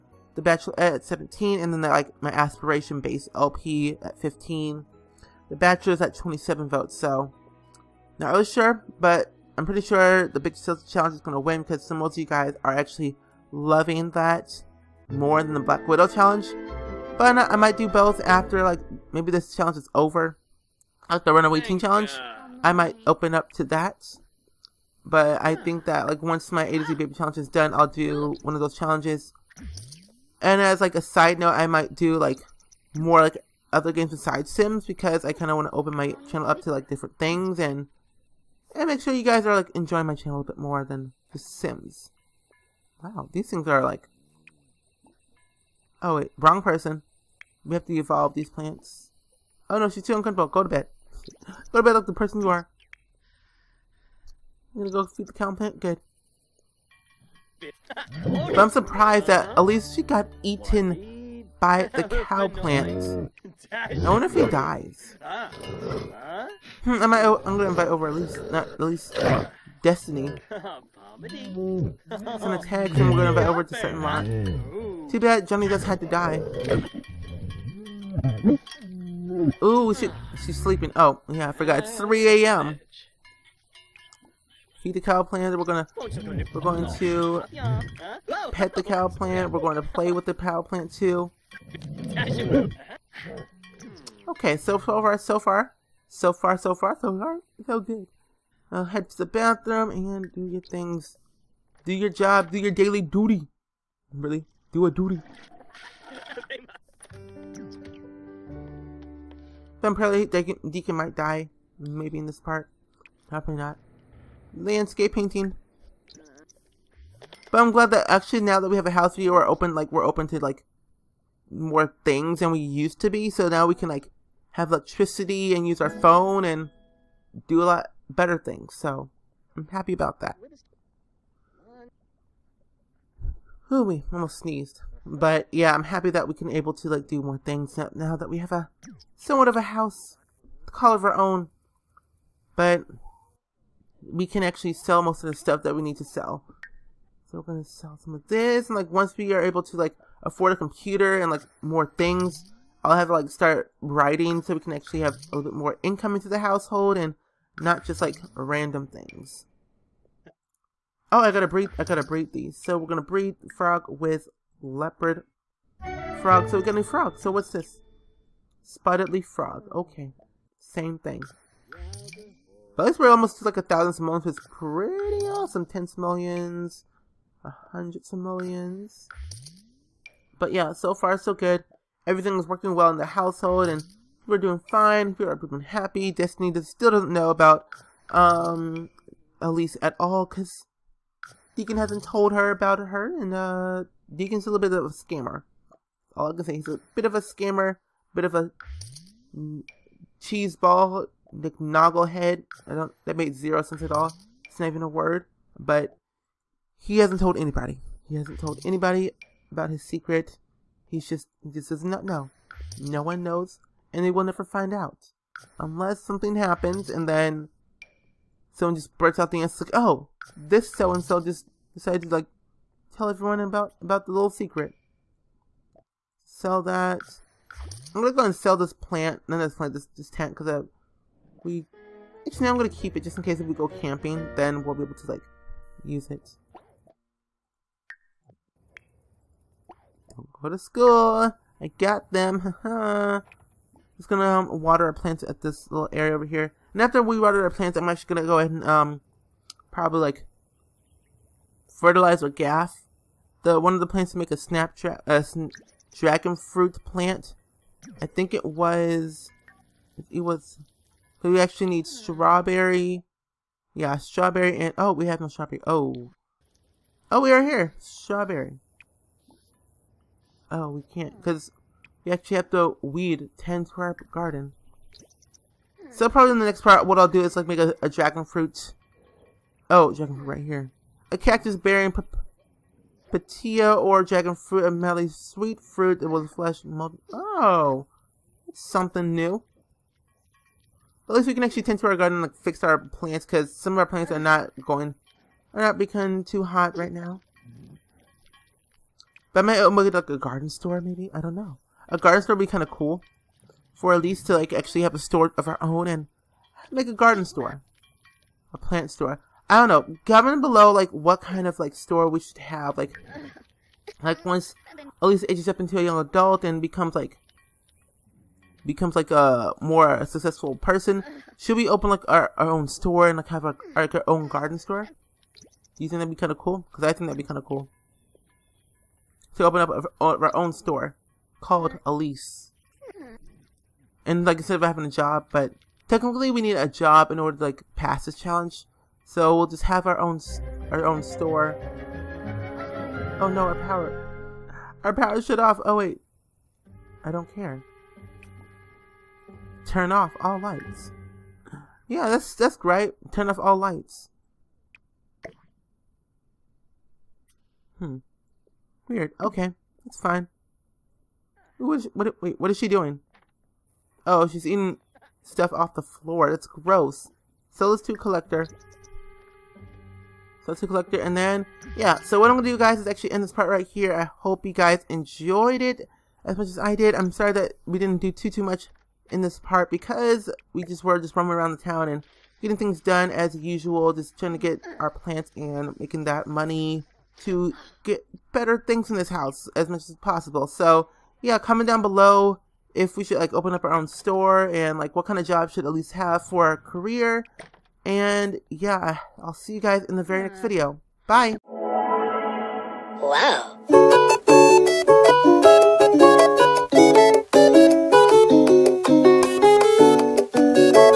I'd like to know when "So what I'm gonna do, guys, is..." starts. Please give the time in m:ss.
6:11.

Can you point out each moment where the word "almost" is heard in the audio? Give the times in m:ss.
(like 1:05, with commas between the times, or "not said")
2:14, 2:53.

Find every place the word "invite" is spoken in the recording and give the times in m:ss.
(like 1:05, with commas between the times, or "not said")
1:07, 1:13.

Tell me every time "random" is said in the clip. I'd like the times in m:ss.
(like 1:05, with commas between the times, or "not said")
2:38.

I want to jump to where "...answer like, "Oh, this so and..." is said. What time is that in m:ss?
3:39.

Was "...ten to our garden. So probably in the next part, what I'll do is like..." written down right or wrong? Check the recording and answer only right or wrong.
right.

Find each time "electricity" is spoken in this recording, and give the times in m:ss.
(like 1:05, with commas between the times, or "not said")
2:04.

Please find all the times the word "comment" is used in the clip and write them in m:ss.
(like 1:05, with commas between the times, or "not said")
5:10, 6:31.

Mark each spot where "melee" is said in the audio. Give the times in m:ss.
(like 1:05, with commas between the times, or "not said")
4:44.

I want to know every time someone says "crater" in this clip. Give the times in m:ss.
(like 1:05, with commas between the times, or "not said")
not said.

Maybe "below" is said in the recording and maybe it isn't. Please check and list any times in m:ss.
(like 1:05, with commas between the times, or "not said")
5:10, 6:31.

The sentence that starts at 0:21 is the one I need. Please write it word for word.
Like the Runaway Teen Challenge, I might open up to that.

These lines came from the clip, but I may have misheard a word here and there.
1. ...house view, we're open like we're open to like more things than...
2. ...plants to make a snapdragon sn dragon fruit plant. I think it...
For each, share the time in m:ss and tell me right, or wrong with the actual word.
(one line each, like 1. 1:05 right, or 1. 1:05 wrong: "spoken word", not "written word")
1. 1:58 right
2. 4:13 right.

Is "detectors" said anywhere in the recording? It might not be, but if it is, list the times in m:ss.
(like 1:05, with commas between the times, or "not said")
not said.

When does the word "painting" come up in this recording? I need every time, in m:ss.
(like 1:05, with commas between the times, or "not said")
1:55.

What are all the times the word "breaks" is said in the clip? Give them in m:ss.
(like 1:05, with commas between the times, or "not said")
3:38.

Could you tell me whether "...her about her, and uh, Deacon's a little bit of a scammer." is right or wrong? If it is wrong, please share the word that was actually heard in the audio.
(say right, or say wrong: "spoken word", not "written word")
right.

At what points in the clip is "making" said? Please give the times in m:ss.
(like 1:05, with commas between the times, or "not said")
6:25.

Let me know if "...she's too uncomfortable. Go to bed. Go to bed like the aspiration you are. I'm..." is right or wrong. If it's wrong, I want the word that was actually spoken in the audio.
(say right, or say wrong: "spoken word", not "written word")
wrong: "person", not "aspiration".